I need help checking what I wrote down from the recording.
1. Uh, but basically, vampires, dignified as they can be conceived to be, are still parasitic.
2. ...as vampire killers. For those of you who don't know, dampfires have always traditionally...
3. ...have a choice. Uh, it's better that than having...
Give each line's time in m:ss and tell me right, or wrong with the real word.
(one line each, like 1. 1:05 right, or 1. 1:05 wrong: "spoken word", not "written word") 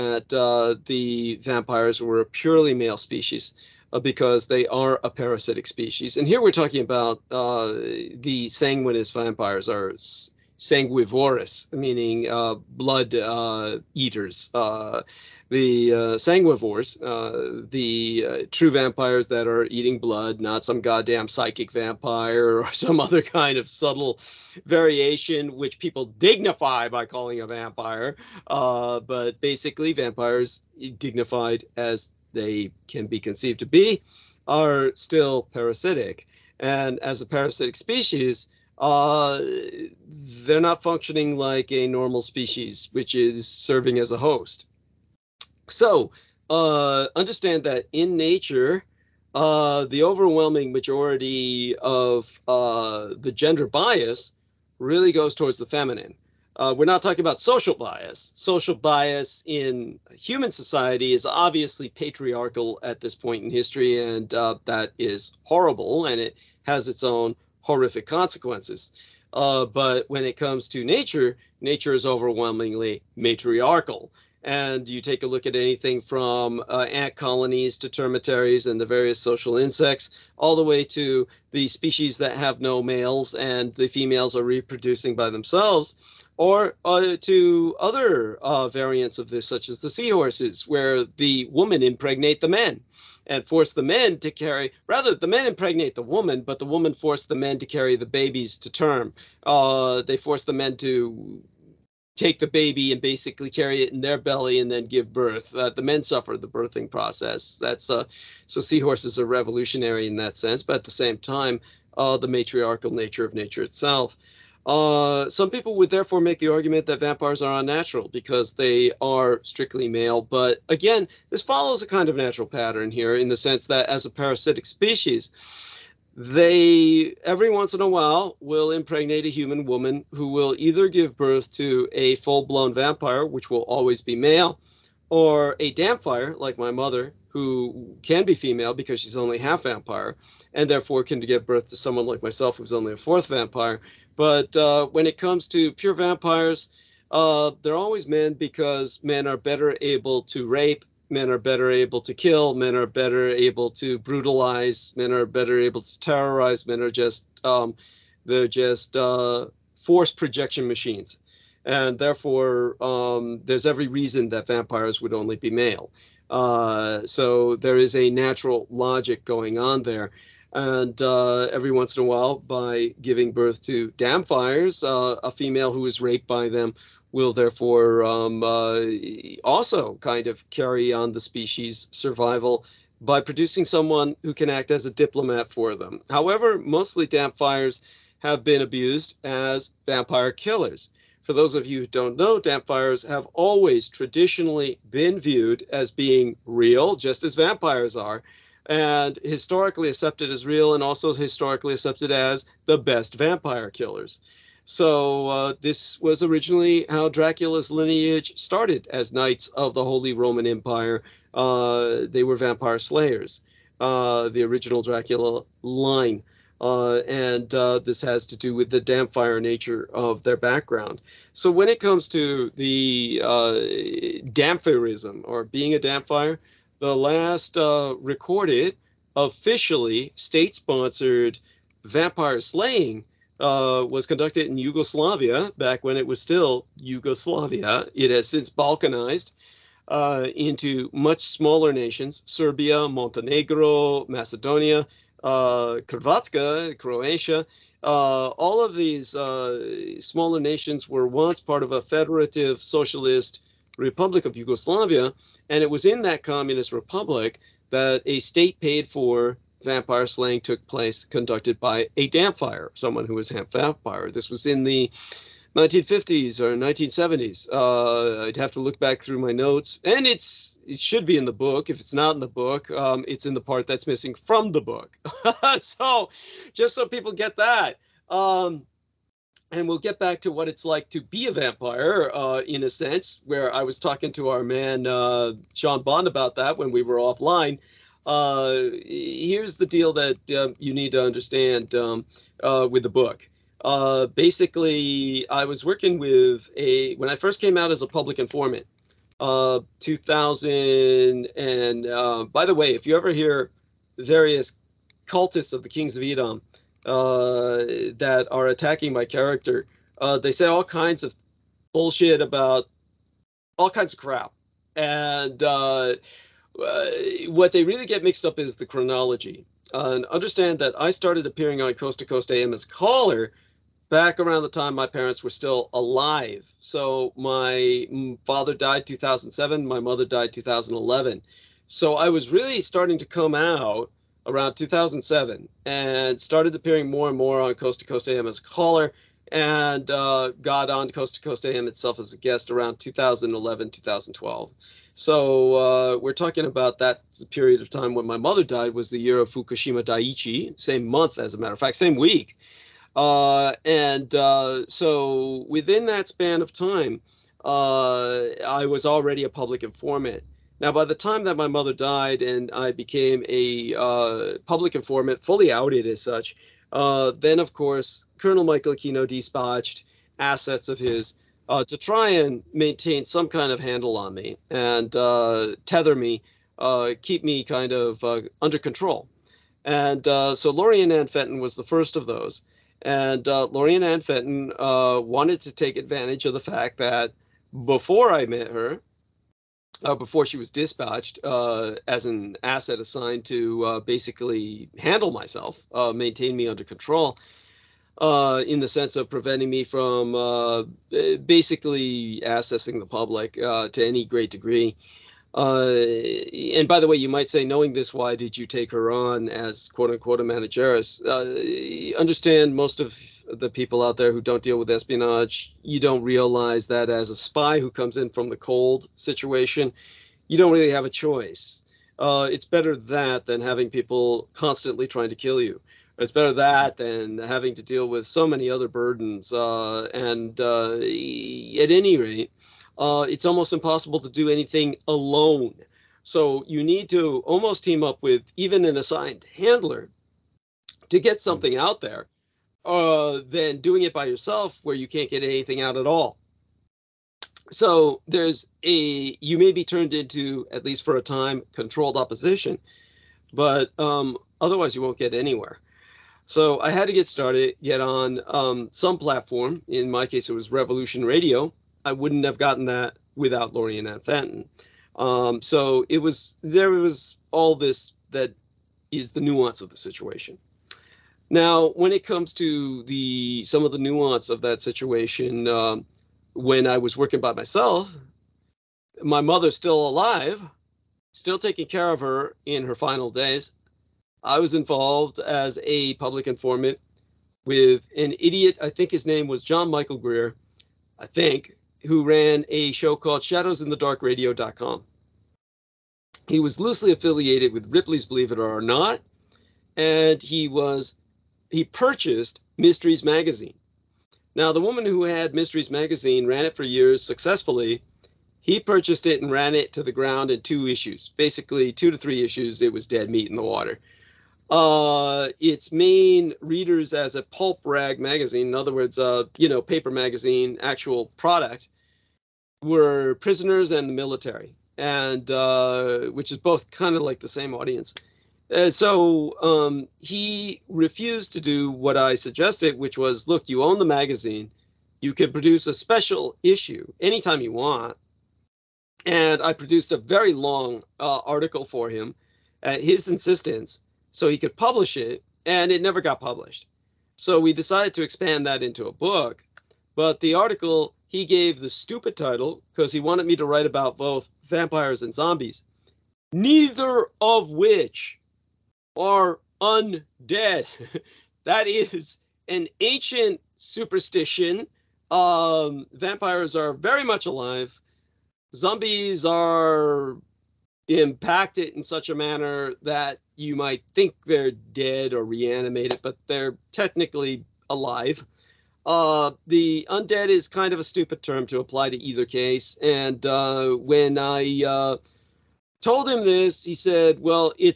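1. 0:28 right
2. 3:09 right
3. 7:00 right.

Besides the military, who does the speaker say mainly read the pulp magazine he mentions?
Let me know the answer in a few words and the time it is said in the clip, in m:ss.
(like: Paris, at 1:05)
Prisoners, at 8:43.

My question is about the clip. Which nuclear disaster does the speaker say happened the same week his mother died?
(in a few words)
Fukushima Daiichi.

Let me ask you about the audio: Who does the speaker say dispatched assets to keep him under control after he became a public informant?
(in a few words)
Michael Aquino.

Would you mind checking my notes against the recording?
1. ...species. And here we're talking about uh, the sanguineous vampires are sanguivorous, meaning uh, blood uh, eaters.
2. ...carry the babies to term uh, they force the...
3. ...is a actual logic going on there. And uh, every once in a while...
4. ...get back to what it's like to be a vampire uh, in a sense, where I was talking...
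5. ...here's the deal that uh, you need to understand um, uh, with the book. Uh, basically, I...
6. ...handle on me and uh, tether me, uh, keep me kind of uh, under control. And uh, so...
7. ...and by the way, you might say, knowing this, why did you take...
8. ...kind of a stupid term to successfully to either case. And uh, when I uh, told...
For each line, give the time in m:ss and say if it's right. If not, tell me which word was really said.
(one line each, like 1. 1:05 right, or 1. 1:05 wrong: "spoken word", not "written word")
1. 0:05 right
2. 1:37 right
3. 2:47 wrong: "natural", not "actual"
4. 4:39 right
5. 4:48 right
6. 6:13 right
7. 6:46 right
8. 9:40 wrong: "apply", not "successfully".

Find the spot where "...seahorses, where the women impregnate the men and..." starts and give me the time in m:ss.
1:29.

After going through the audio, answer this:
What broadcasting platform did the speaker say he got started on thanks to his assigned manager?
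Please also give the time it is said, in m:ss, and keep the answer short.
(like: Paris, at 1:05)
Revolution Radio, at 7:40.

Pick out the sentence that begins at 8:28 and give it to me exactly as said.
He purchased it and ran it to the ground in two issues, basically two to three issues.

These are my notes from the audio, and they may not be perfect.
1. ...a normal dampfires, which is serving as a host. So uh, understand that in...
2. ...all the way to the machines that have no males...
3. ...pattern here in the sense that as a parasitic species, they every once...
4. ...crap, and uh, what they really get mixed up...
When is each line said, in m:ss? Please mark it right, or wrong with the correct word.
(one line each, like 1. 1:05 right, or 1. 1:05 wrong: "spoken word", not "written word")
1. 0:41 wrong: "species", not "dampfires"
2. 1:20 wrong: "species", not "machines"
3. 2:02 right
4. 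5:13 right.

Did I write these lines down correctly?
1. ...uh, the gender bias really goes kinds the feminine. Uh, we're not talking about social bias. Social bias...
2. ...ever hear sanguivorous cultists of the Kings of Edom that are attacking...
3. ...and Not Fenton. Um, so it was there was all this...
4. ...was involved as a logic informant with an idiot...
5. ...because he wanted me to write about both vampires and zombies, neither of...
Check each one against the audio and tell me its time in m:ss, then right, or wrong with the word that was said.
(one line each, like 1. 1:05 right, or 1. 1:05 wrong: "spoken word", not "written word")
1. 0:52 wrong: "towards", not "kinds"
2. 5:02 wrong: "various", not "sanguivorous"
3. 7:43 wrong: "Ann", not "Not"
4. 8:04 wrong: "public", not "logic"
5. 9:12 right.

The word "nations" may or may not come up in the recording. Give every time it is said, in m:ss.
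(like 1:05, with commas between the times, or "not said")
4:01, 4:10.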